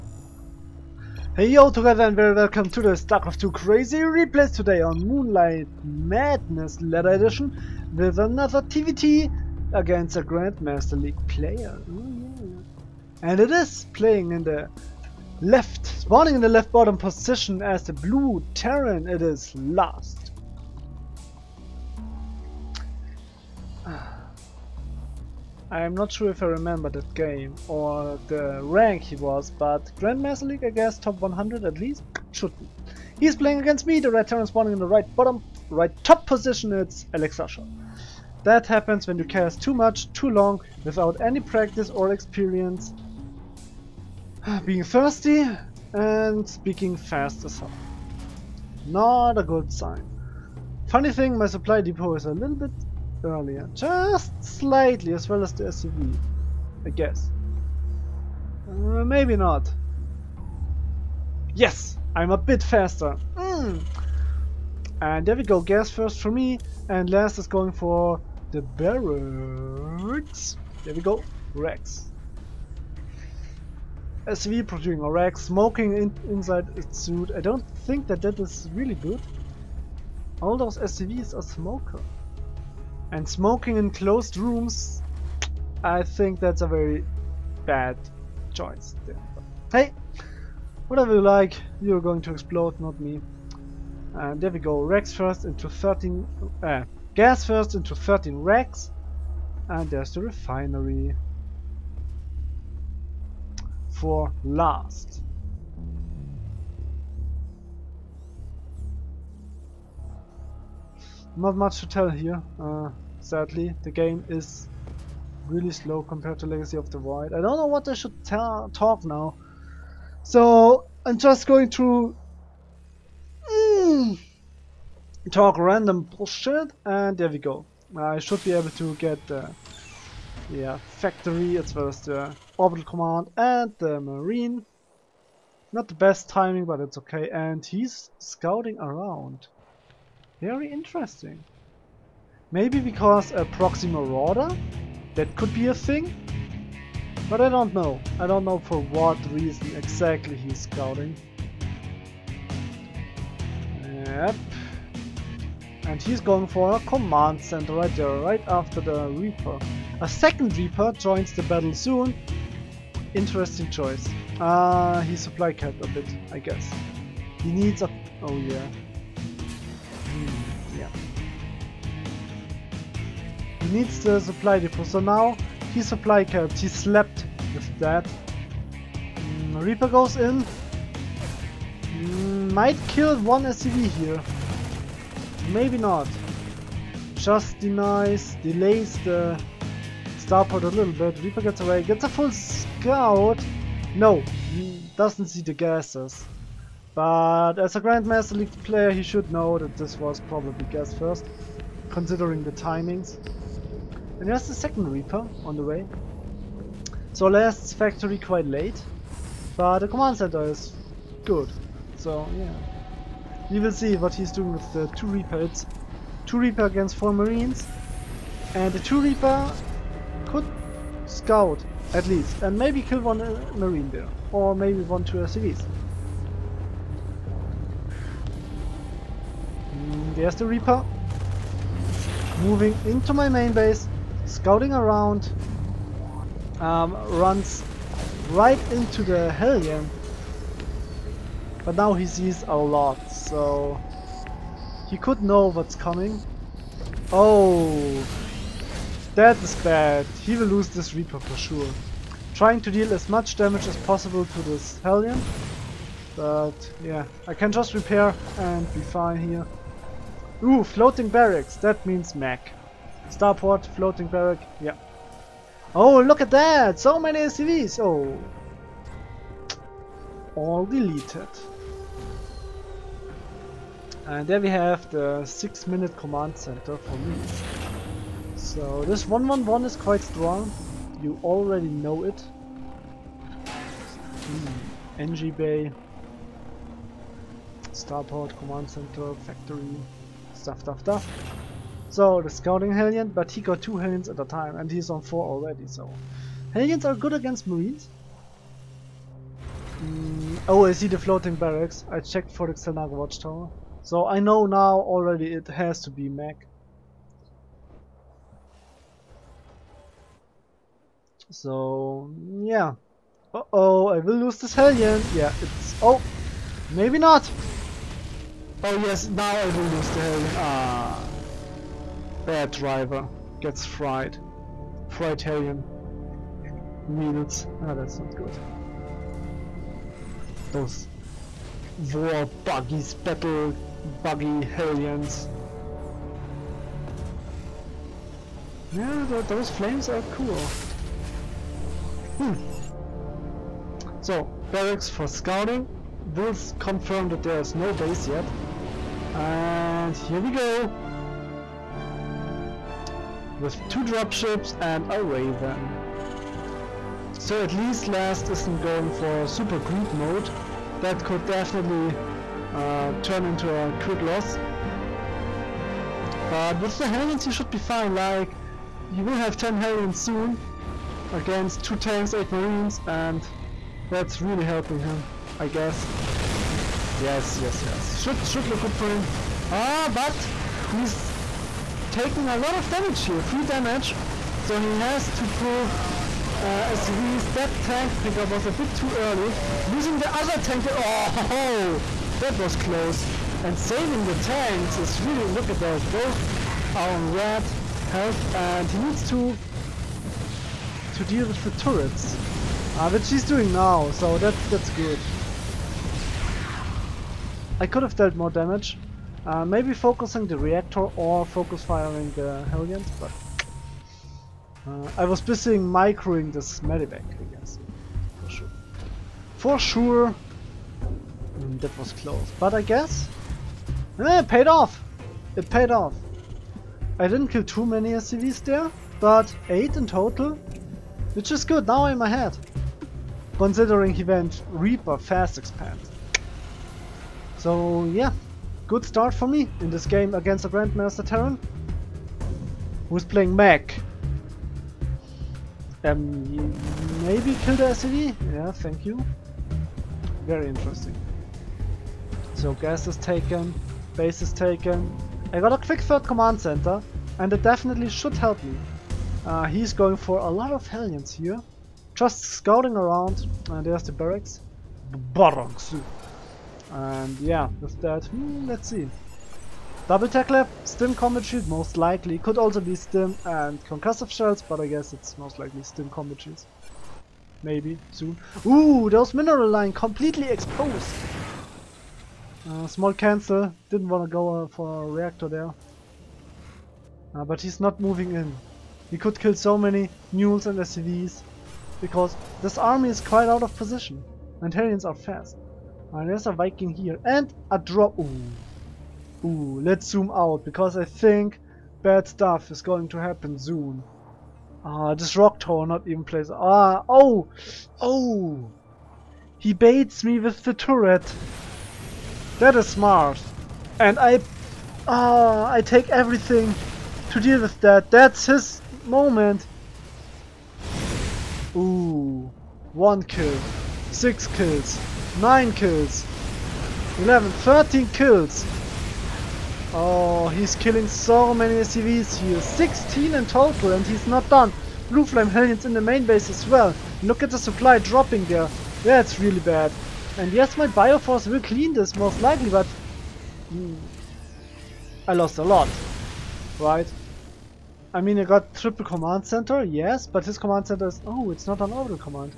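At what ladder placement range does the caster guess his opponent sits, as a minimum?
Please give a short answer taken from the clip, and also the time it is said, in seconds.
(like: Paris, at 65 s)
top 100, at 30 s.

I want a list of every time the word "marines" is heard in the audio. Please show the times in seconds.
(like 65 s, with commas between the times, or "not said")
134 s, 217 s, 223 s, 297 s, 372 s.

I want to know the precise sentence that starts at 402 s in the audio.
Uh, which he's doing now, so that's, that's good.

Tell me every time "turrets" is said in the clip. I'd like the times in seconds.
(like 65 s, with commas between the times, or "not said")
401 s, 510 s.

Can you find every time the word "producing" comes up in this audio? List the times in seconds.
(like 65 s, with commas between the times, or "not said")
74 s.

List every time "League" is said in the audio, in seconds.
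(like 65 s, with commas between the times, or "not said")
11 s, 30 s, 198 s.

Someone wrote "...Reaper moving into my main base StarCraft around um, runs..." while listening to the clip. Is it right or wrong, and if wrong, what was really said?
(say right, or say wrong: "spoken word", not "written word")
wrong: "Scouting", not "StarCraft".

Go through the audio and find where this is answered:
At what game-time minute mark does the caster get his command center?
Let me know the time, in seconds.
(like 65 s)
275 s.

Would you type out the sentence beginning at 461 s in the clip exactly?
Just scouting around, and there's the barracks.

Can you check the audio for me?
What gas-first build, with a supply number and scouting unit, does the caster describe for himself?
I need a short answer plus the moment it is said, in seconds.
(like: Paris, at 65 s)
13 Rex, at 97 s.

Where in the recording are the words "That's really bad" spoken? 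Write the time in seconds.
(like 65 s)
538 s.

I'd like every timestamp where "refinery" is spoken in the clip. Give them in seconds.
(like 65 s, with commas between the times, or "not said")
100 s.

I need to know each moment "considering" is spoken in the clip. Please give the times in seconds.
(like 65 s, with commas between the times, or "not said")
201 s, 433 s.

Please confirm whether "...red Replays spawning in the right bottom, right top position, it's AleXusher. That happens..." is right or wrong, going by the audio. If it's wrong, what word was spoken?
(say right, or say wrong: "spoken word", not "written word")
wrong: "Terran", not "Replays".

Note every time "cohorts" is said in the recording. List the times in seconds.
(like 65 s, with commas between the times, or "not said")
not said.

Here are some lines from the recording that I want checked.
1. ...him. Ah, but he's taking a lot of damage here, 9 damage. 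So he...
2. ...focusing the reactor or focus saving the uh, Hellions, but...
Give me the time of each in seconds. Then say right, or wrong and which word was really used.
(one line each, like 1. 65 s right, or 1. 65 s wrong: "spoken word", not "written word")
1. 378 s wrong: "3", not "9"
2. 409 s wrong: "firing", not "saving".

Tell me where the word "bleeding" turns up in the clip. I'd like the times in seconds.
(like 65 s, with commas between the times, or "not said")
not said.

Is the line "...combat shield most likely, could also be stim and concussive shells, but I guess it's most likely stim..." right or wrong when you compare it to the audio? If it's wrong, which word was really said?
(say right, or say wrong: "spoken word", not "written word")
right.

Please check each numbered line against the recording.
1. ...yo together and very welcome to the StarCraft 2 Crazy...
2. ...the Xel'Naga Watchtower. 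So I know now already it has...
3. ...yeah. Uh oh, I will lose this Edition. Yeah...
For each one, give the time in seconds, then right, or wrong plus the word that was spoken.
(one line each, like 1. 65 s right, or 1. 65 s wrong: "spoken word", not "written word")
1. 1 s right
2. 302 s right
3. 312 s wrong: "Hellion", not "Edition".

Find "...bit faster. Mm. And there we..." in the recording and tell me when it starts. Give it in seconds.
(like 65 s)
62 s.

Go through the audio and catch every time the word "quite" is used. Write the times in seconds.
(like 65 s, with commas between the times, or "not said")
208 s, 279 s, 493 s.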